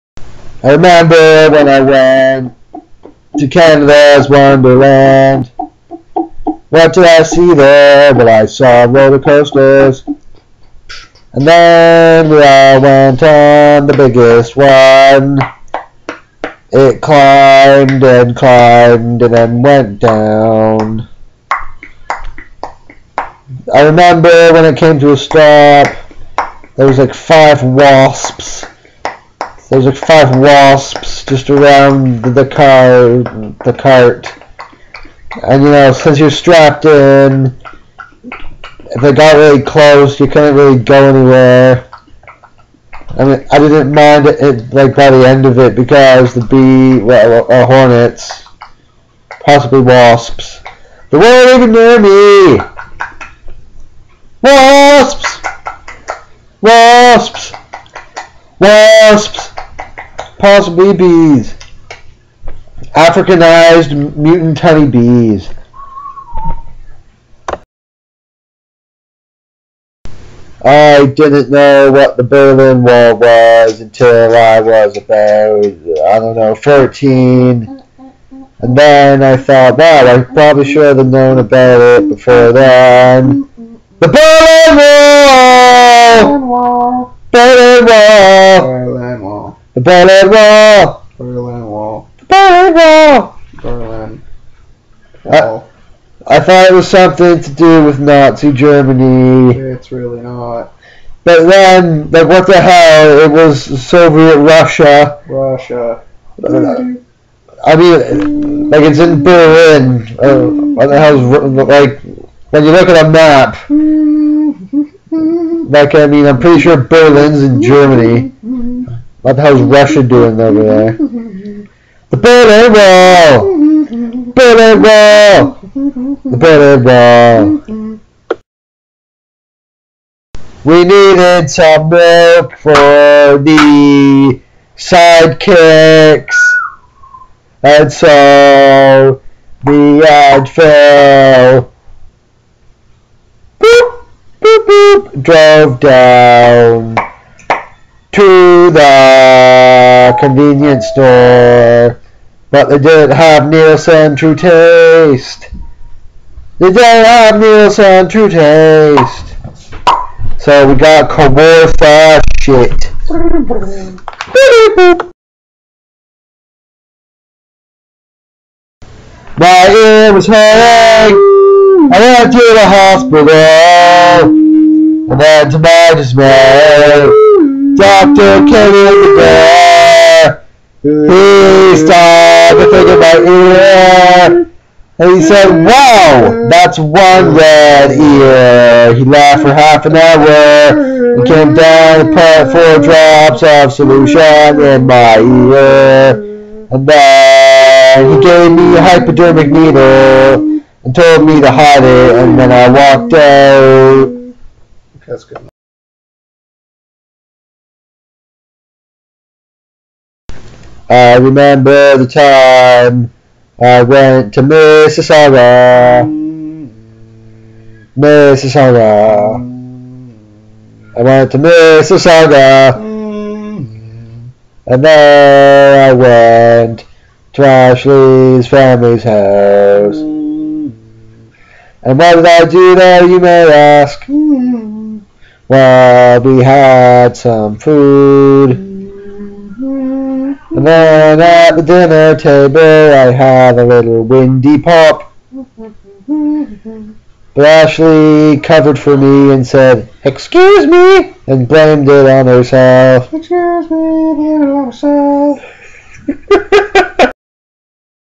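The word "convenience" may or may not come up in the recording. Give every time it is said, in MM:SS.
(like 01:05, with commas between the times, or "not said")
02:30.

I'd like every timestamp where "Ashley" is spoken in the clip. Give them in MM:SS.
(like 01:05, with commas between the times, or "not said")
03:47, 04:07.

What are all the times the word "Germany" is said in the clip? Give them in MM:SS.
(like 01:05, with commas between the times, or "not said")
01:38, 01:57.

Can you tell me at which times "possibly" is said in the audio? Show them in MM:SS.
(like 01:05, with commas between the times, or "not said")
00:49, 01:00.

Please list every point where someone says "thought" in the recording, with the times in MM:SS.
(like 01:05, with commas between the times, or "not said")
01:19, 01:36.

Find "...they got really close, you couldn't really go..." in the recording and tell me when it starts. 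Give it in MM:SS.
00:39.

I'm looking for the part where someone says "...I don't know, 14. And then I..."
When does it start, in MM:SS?
01:15.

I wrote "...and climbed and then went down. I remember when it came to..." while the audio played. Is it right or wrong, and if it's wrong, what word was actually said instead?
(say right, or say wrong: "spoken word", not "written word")
right.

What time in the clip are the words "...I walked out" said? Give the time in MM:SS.
03:22.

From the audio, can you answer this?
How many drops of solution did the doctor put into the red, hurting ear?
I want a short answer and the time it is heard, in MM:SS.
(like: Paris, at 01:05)
4, at 03:12.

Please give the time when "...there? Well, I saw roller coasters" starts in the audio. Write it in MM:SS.
00:07.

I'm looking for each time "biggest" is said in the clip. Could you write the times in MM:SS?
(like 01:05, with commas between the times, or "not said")
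00:13.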